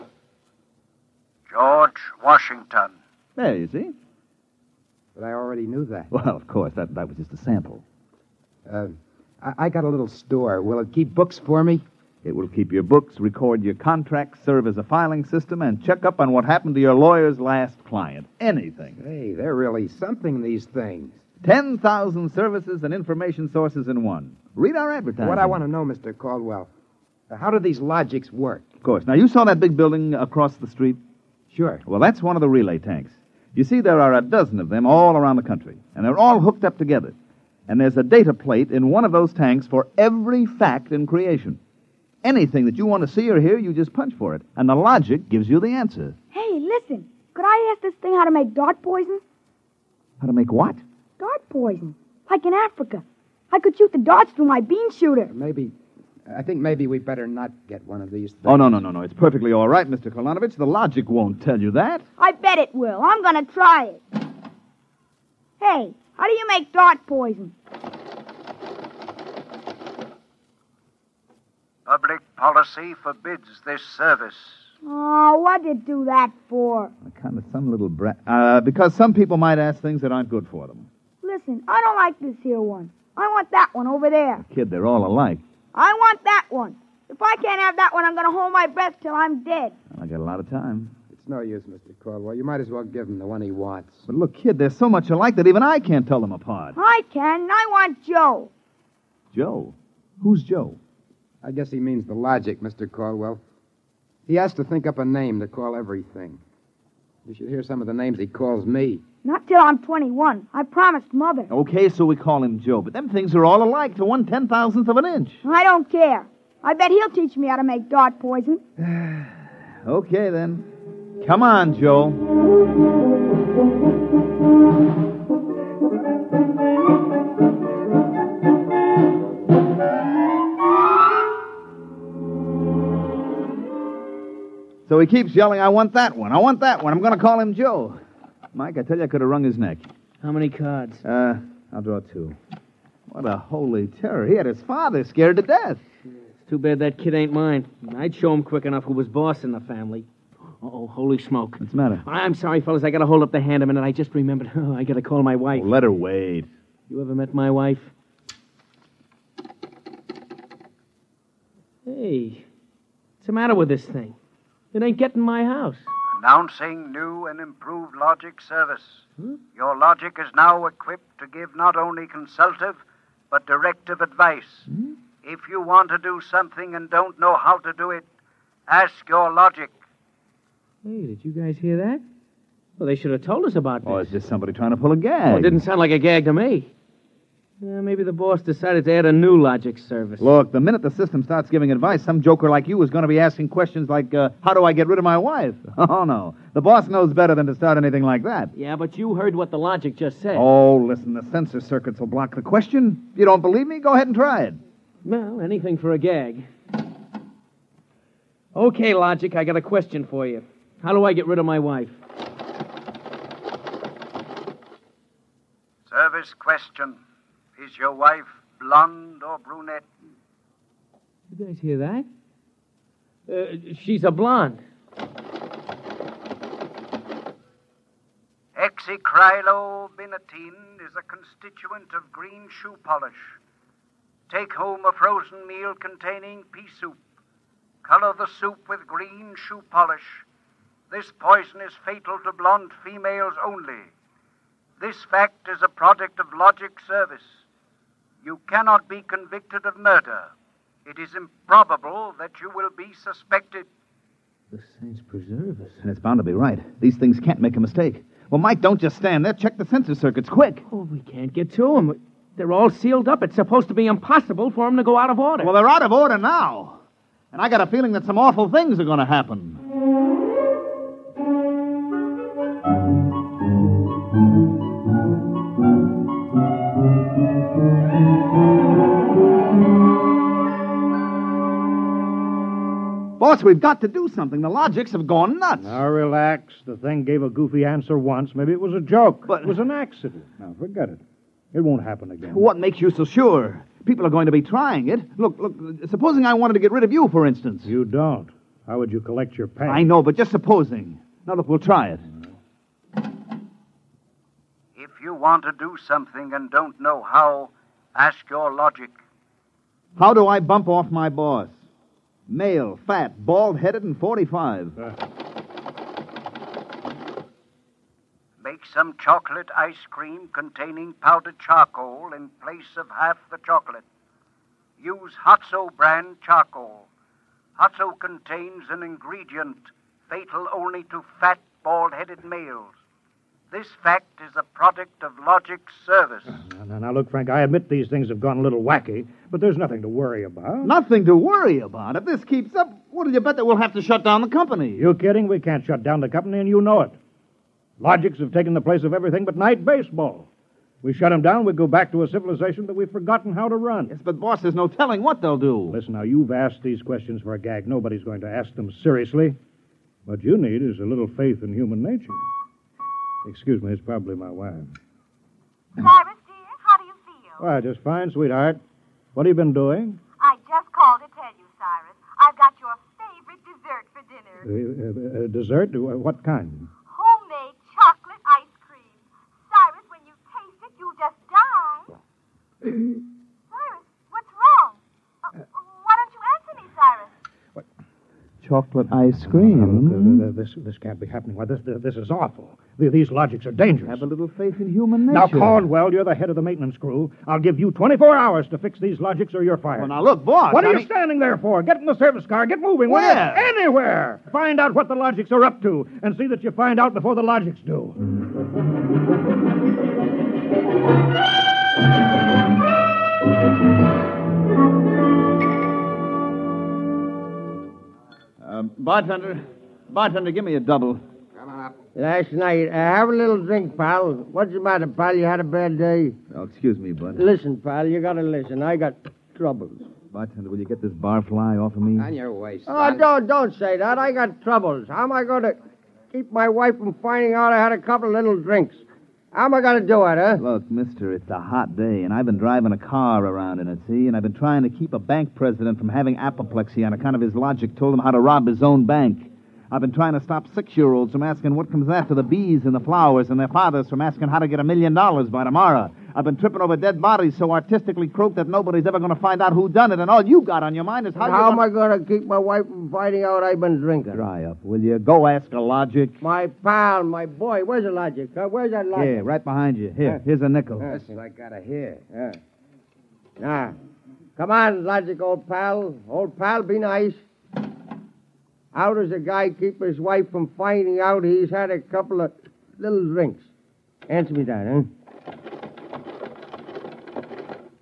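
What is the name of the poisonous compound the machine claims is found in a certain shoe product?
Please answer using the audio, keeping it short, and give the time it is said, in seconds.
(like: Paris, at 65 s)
Hexacrylobinatine, at 228 s.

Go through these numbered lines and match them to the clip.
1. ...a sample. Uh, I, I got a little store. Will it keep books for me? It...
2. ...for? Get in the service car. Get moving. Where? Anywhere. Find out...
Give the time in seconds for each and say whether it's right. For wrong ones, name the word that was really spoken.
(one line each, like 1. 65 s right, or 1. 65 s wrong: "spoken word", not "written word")
1. 7 s right
2. 401 s right.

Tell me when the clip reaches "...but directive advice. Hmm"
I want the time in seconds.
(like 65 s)
173 s.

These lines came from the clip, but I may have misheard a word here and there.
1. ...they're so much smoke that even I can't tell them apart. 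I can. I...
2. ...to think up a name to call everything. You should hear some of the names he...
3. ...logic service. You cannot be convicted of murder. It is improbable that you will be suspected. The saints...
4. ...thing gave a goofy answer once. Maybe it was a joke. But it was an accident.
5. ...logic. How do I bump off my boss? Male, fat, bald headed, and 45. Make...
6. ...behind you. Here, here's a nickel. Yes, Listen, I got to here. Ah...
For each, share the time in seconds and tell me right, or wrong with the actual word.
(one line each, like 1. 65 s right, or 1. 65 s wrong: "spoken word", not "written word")
1. 94 s wrong: "alike", not "smoke"
2. 104 s right
3. 246 s right
4. 286 s right
5. 308 s right
6. 469 s right.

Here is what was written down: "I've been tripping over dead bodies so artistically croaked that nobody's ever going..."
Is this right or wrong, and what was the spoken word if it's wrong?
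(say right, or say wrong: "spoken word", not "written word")
right.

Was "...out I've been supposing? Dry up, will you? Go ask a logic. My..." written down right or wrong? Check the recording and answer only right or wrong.
wrong.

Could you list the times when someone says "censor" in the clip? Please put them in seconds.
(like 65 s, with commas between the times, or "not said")
201 s, 259 s.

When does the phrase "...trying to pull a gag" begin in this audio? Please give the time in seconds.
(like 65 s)
184 s.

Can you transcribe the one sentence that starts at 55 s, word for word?
Maybe I think maybe we better not get one of these things.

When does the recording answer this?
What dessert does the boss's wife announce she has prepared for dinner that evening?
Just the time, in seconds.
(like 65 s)
376 s.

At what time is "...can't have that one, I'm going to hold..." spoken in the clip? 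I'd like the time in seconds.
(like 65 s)
87 s.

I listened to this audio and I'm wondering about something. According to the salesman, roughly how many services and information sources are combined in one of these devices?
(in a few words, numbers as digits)
10,000.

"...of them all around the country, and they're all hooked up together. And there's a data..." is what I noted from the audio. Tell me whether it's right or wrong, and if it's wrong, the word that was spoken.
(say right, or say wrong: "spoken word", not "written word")
right.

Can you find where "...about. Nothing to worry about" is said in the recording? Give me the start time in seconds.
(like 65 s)
340 s.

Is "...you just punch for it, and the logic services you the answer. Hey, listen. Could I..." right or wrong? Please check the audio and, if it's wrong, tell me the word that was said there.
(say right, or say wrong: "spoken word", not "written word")
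wrong: "gives", not "services".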